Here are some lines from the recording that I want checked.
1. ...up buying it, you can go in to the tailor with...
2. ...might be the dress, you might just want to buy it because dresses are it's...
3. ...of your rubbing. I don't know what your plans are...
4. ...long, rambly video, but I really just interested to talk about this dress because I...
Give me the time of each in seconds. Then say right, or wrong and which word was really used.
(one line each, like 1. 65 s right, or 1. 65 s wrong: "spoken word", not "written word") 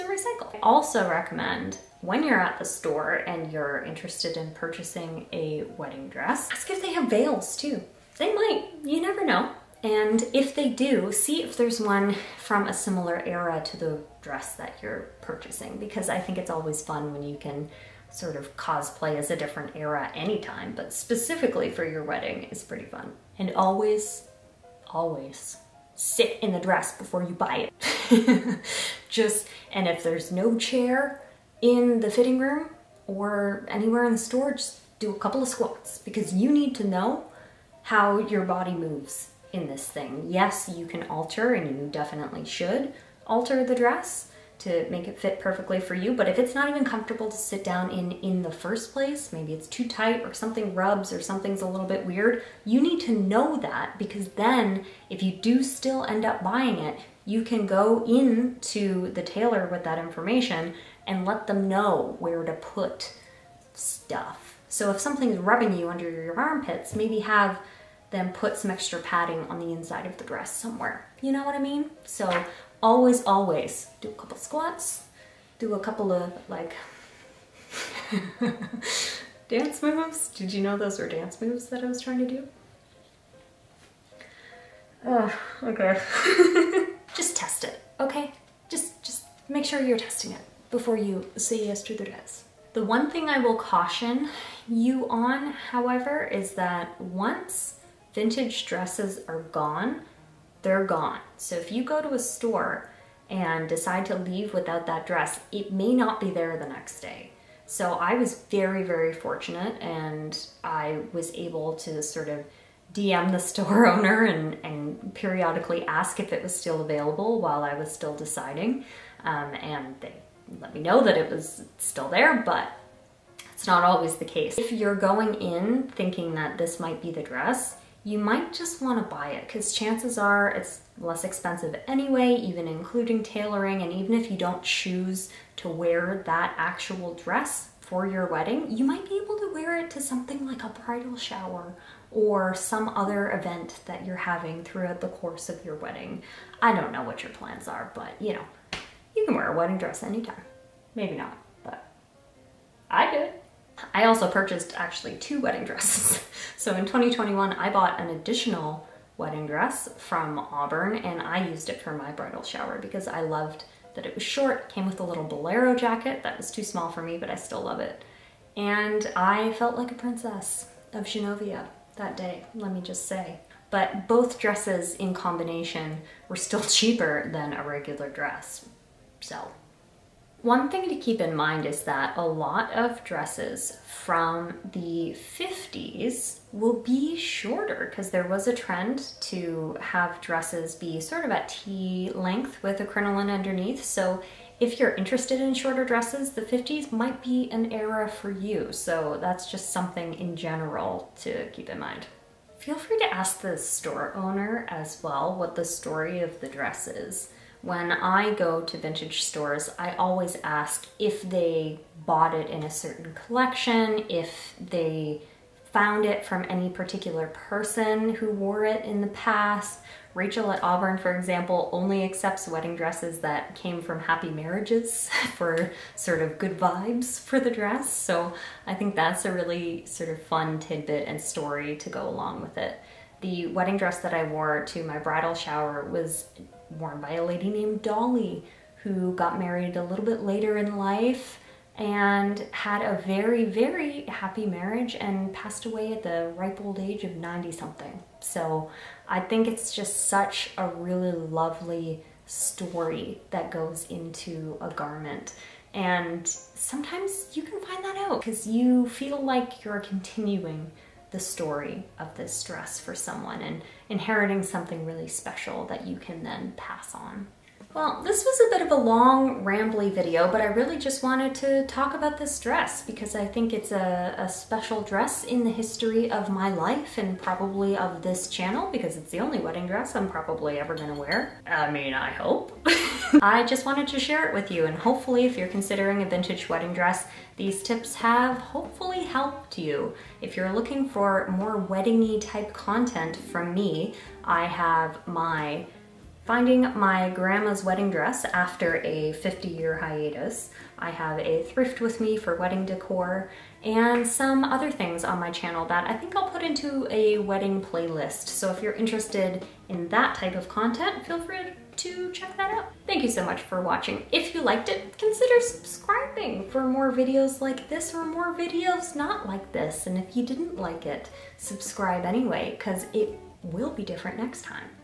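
1. 56 s right
2. 126 s wrong: "chances", not "dresses"
3. 145 s wrong: "wedding", not "rubbing"
4. 268 s wrong: "wanted", not "interested".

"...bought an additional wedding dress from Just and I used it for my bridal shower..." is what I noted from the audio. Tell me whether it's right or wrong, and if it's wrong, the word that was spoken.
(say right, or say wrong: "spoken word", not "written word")
wrong: "Auburn", not "Just".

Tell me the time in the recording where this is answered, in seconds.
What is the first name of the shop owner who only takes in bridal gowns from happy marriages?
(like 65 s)
220 s.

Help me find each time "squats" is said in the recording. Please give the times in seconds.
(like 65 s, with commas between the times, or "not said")
35 s, 74 s.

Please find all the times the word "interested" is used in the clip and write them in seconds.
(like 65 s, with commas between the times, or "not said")
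3 s, 194 s, 308 s.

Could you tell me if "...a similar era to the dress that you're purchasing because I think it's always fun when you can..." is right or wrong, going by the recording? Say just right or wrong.
right.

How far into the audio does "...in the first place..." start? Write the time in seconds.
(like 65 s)
48 s.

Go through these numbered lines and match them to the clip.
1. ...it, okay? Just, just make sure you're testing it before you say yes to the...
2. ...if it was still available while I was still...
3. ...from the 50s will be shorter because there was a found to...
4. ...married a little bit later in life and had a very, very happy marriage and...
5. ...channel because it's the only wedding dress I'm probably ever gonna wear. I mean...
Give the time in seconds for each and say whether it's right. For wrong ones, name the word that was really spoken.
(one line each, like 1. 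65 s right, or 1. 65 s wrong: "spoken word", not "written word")
1. 87 s right
2. 116 s right
3. 183 s wrong: "trend", not "found"
4. 239 s right
5. 278 s right.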